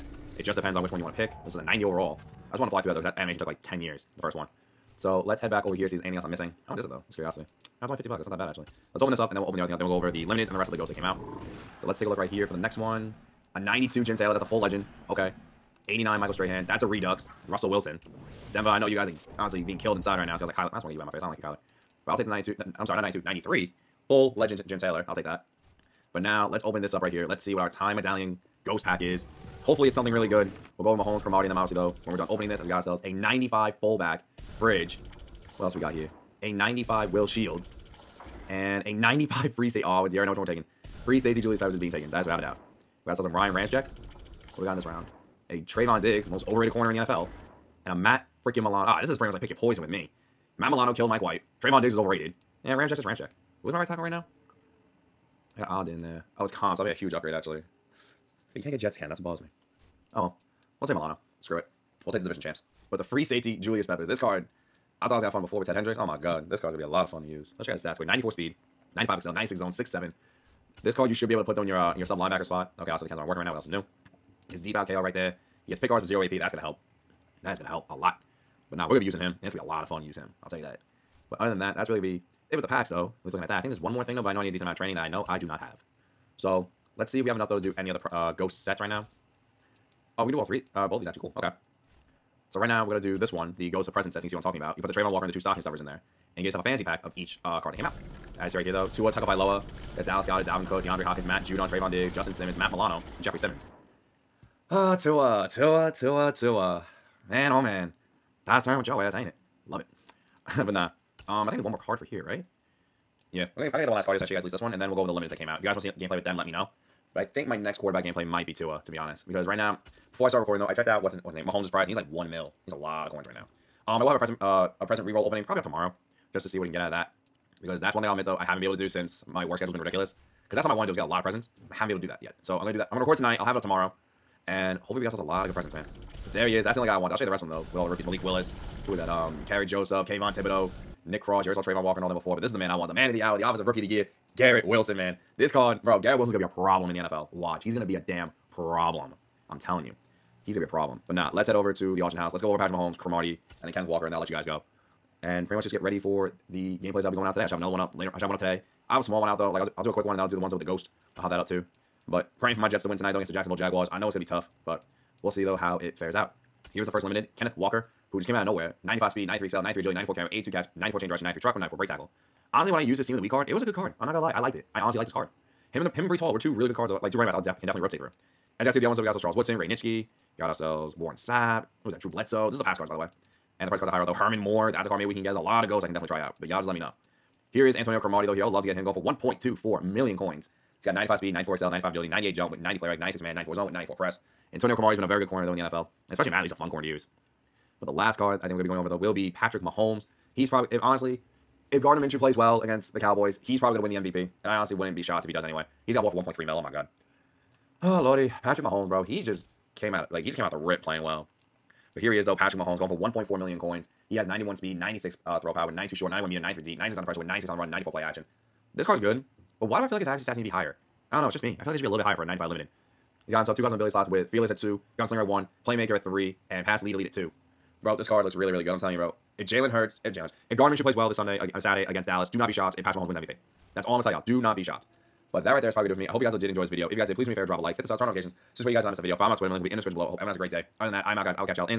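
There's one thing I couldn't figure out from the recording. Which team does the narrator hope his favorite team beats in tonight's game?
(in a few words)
Jacksonville Jaguars.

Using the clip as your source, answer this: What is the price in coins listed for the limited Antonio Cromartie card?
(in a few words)
1.24 million coins.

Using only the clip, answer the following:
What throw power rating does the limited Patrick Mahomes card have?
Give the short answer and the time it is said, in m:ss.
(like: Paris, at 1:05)
96, at 3:34.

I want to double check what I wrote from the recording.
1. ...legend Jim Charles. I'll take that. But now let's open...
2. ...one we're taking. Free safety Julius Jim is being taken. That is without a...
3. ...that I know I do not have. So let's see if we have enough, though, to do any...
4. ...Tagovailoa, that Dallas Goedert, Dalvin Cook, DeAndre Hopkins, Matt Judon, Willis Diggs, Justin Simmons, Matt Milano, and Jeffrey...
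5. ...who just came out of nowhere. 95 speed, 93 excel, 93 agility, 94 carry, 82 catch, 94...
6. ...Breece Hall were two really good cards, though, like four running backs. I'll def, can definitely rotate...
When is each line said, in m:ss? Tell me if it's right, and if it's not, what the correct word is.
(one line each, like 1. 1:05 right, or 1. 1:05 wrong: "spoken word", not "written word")
1. 0:24 wrong: "Taylor", not "Charles"
2. 0:40 wrong: "Peppers", not "Jim"
3. 1:24 right
4. 1:39 wrong: "Trevon", not "Willis"
5. 2:48 right
6. 2:56 wrong: "two", not "four".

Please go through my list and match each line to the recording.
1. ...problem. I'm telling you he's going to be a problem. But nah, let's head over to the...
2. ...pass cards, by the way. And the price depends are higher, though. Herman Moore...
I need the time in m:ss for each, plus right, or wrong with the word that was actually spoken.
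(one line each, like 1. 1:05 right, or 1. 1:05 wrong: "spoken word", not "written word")
1. 2:28 right
2. 3:02 wrong: "cards", not "depends".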